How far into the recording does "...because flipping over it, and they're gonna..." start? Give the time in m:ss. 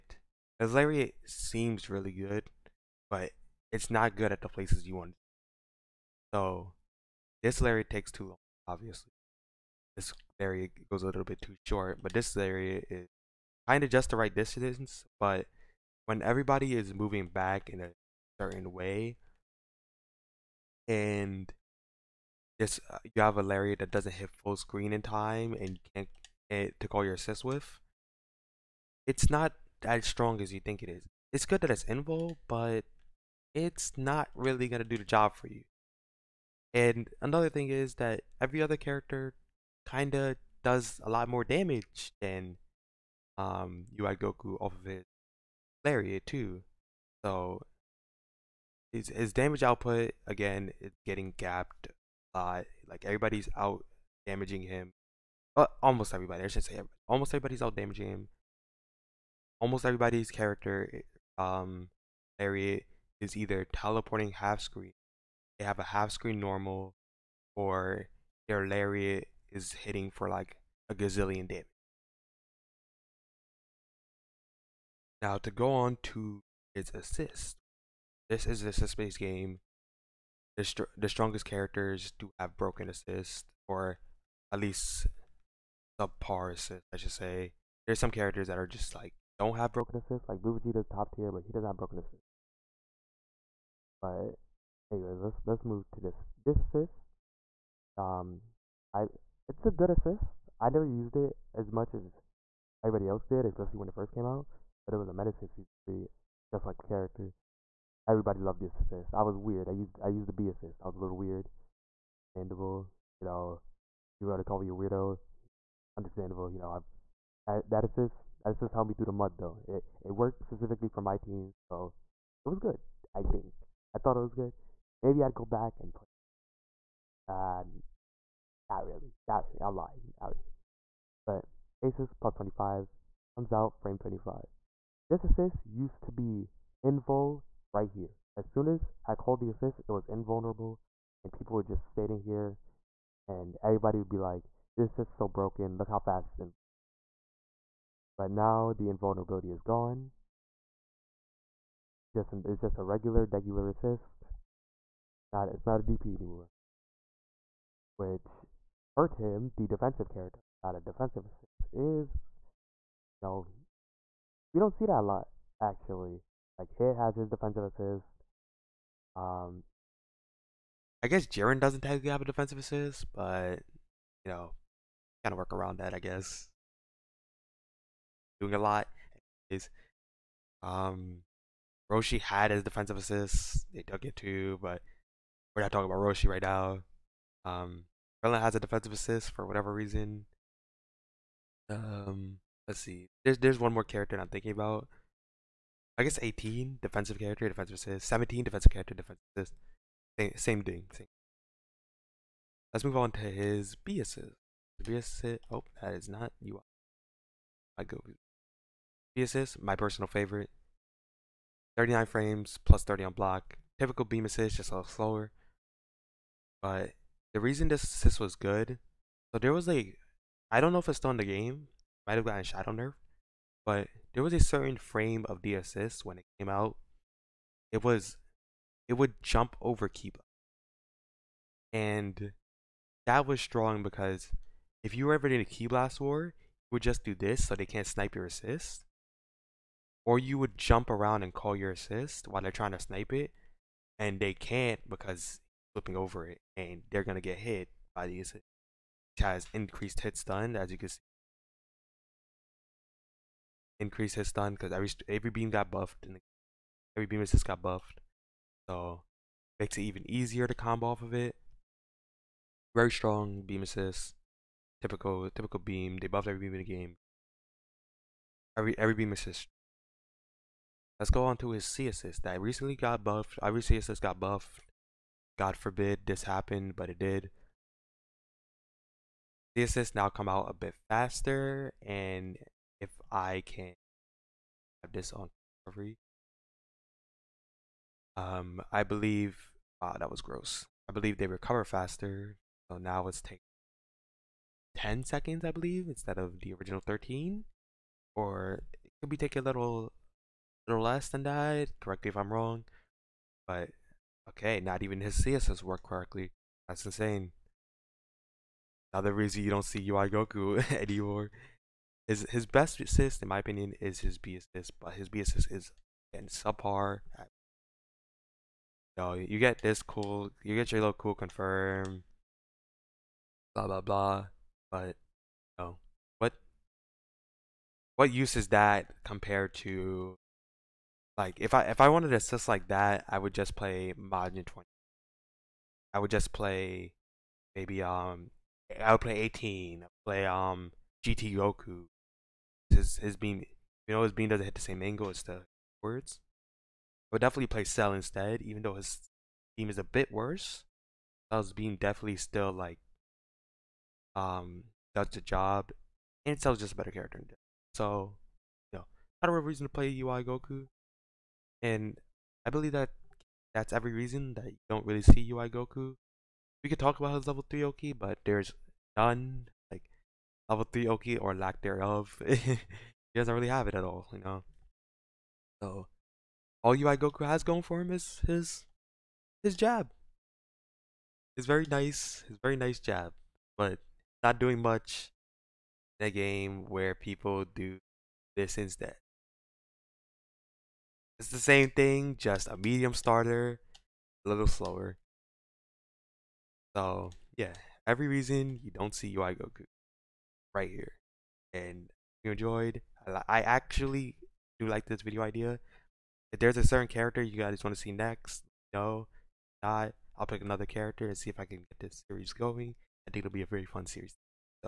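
4:04.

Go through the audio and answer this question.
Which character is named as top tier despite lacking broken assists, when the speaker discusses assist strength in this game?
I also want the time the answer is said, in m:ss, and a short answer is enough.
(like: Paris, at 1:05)
Blue Vegeta, at 1:30.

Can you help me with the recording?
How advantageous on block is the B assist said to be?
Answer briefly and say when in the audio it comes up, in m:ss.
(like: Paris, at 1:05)
+30, at 3:32.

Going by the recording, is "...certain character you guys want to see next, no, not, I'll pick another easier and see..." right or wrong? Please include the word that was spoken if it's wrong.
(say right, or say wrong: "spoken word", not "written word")
wrong: "character", not "easier".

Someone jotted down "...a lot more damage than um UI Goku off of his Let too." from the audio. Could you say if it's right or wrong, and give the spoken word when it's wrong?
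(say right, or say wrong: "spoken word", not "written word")
wrong: "Lariat", not "Let".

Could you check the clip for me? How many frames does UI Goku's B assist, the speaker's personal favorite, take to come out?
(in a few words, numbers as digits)
39.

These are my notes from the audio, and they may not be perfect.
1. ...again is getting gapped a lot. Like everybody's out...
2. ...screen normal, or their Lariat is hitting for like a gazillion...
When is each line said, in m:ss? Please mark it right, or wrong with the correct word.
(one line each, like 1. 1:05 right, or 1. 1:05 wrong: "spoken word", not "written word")
1. 0:50 right
2. 1:06 right.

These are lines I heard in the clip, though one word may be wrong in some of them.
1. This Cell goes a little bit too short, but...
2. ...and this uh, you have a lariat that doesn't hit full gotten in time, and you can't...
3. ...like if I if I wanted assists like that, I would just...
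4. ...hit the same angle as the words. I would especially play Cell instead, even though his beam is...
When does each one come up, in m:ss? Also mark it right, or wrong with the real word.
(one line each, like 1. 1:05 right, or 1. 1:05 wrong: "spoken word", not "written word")
1. 0:09 wrong: "Lariat", not "Cell"
2. 0:20 wrong: "screen", not "gotten"
3. 5:31 right
4. 5:44 wrong: "definitely", not "especially".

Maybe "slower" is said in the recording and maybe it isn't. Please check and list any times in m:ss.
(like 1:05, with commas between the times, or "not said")
3:34, 6:34.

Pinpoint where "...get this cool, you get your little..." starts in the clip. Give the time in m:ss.
5:19.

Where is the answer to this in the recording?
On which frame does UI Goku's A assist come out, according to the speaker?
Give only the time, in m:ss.
2:13.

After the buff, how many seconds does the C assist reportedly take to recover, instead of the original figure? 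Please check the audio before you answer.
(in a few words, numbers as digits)
10 seconds.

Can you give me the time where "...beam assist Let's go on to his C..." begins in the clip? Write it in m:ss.
4:28.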